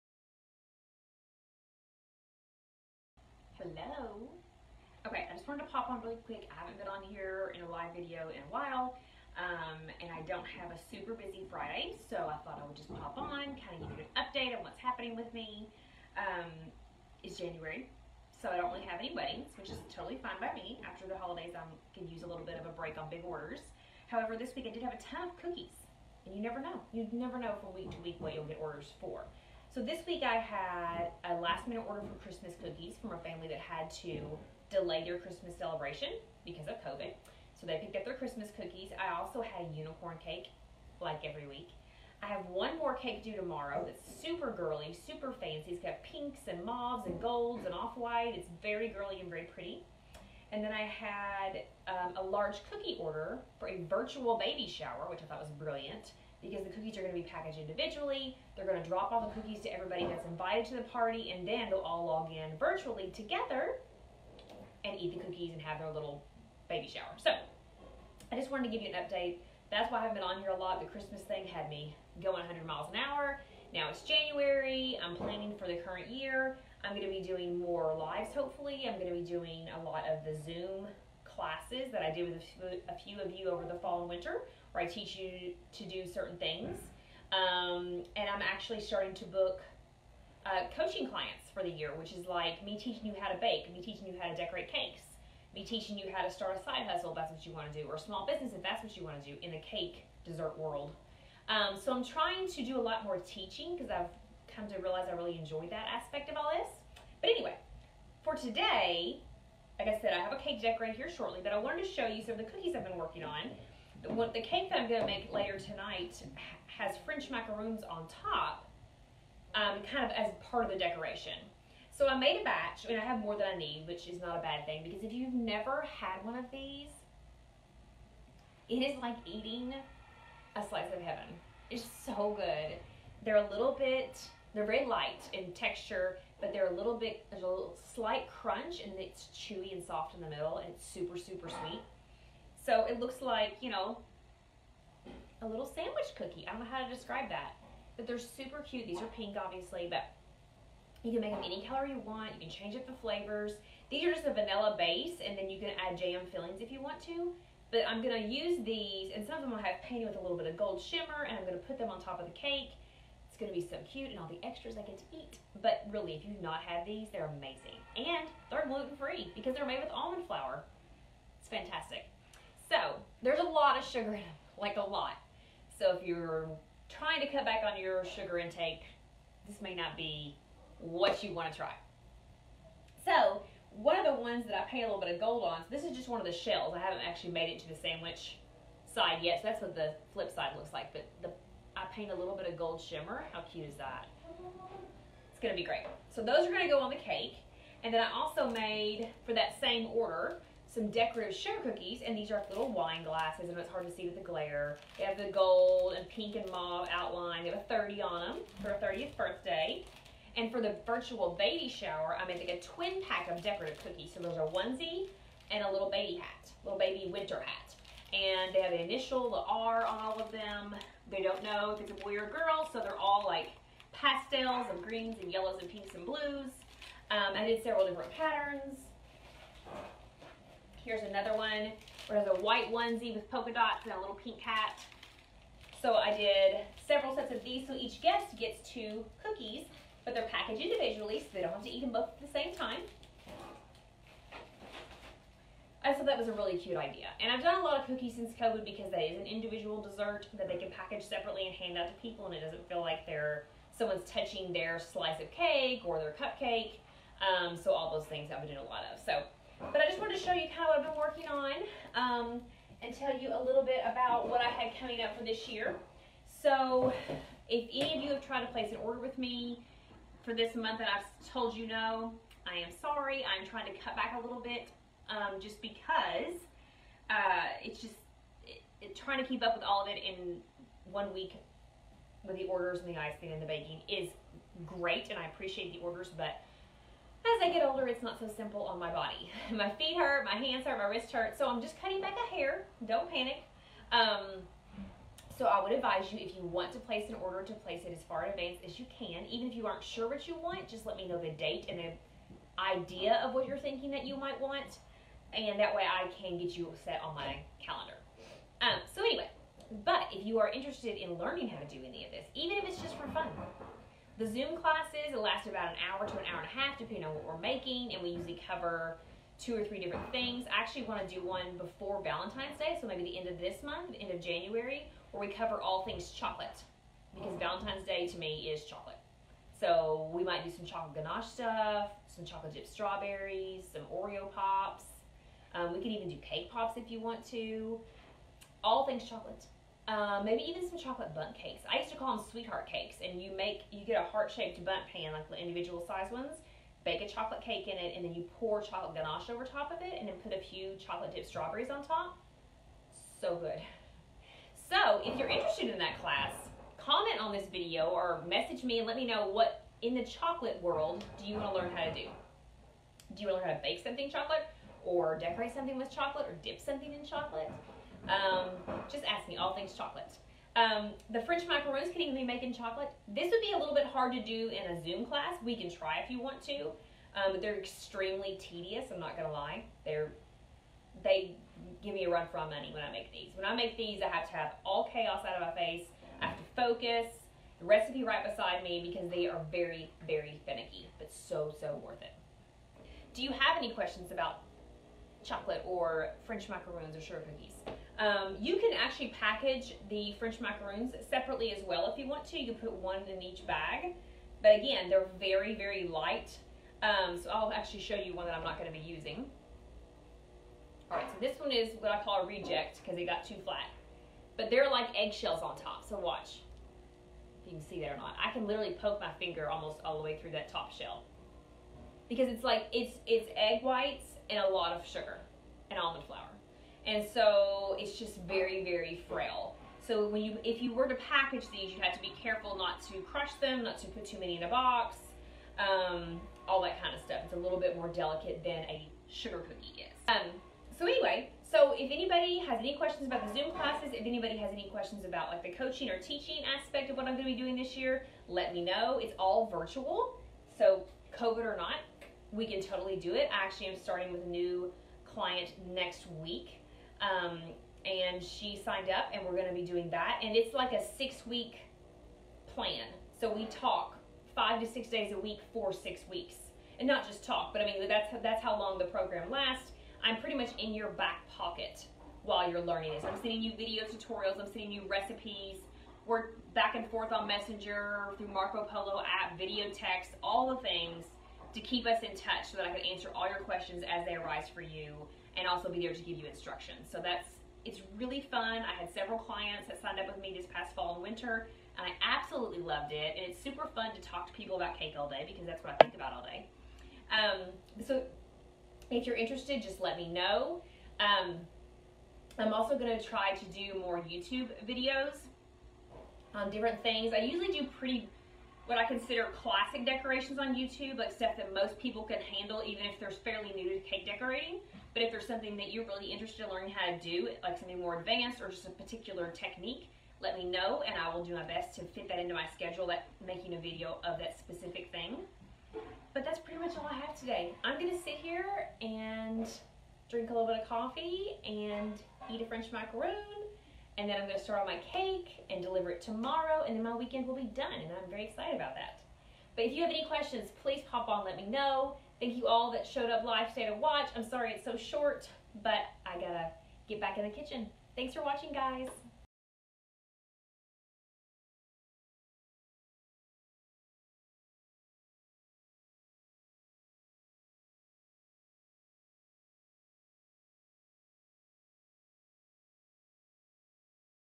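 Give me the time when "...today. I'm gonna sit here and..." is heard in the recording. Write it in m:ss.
8:47.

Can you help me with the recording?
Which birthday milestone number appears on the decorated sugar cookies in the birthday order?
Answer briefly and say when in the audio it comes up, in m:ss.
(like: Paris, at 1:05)
30, at 3:27.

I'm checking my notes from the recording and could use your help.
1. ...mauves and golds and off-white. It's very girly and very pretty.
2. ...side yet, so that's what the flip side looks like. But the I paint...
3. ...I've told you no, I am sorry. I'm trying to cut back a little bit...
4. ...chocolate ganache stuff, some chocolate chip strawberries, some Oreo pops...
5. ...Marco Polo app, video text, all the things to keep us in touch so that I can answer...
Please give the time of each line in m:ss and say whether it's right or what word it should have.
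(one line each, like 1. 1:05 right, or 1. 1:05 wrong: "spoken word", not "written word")
1. 0:46 right
2. 3:08 right
3. 4:30 right
4. 5:30 right
5. 7:58 right.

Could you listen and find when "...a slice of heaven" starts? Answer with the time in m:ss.
2:10.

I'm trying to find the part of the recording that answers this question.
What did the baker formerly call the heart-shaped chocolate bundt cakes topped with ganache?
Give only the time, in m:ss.
5:42.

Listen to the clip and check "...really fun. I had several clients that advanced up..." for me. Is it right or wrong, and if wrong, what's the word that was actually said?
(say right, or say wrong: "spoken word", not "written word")
wrong: "signed", not "advanced".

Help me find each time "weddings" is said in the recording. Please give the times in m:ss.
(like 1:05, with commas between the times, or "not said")
0:19.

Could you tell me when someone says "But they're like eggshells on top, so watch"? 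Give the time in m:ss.
6:54.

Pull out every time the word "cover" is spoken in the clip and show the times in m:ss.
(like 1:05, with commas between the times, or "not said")
5:18, 5:25.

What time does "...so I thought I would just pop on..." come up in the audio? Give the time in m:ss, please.
0:12.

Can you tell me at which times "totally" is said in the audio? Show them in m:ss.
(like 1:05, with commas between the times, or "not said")
0:19, 7:32.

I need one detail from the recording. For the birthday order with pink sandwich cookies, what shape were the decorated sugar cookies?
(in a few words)
wine glasses.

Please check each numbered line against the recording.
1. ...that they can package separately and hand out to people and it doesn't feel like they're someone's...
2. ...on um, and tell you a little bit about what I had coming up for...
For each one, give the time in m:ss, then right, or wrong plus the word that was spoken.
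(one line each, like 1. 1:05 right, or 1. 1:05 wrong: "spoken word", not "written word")
1. 4:10 right
2. 4:21 right.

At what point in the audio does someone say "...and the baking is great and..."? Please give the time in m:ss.
4:43.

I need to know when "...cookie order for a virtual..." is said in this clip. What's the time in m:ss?
0:52.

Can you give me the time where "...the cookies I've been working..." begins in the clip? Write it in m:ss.
1:52.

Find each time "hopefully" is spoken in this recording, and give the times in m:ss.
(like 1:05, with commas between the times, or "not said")
1:18.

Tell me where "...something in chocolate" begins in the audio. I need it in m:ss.
6:06.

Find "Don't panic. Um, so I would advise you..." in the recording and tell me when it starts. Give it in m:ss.
4:52.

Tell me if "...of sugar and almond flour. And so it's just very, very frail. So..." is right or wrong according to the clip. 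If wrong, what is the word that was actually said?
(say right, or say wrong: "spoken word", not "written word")
right.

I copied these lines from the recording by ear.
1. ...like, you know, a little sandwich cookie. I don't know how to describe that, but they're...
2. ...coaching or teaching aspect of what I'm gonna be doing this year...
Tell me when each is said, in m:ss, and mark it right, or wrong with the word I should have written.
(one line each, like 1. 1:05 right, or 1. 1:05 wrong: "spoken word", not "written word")
1. 2:23 right
2. 7:25 right.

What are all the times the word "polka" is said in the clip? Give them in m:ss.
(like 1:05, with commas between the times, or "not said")
3:53.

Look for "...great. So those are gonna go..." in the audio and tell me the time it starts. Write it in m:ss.
3:15.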